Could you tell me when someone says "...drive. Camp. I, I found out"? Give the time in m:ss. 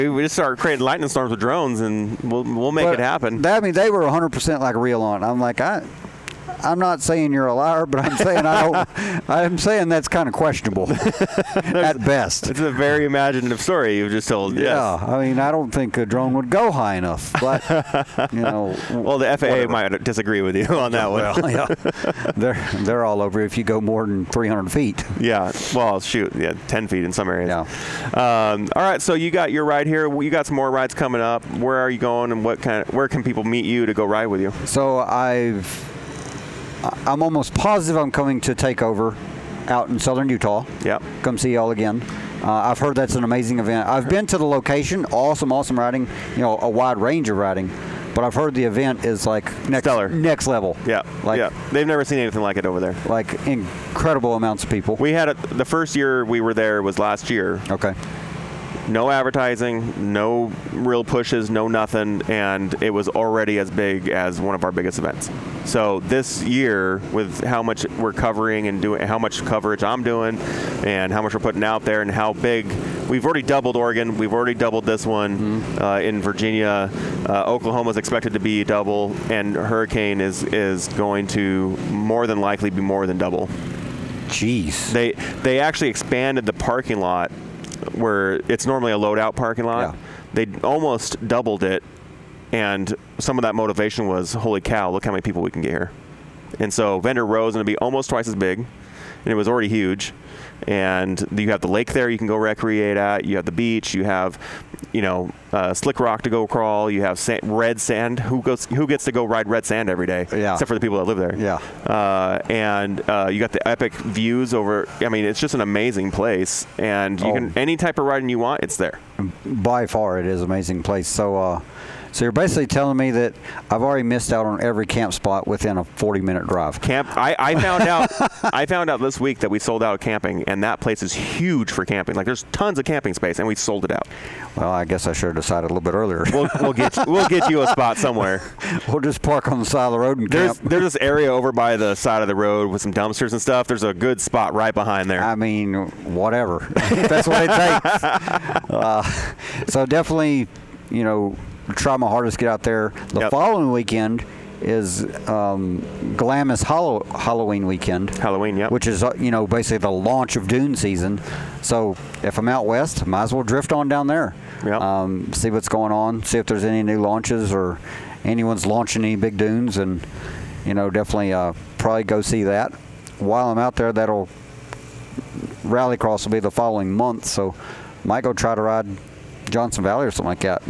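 2:06.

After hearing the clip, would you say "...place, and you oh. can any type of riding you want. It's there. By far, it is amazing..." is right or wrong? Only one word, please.
right.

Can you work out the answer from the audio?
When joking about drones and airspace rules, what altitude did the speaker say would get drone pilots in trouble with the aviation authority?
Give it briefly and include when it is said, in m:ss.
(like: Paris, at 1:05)
300 feet, at 0:24.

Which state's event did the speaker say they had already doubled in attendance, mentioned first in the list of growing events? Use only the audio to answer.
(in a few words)
Oregon.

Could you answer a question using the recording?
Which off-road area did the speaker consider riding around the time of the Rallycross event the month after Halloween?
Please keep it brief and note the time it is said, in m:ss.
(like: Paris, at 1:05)
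Johnson Valley, at 2:59.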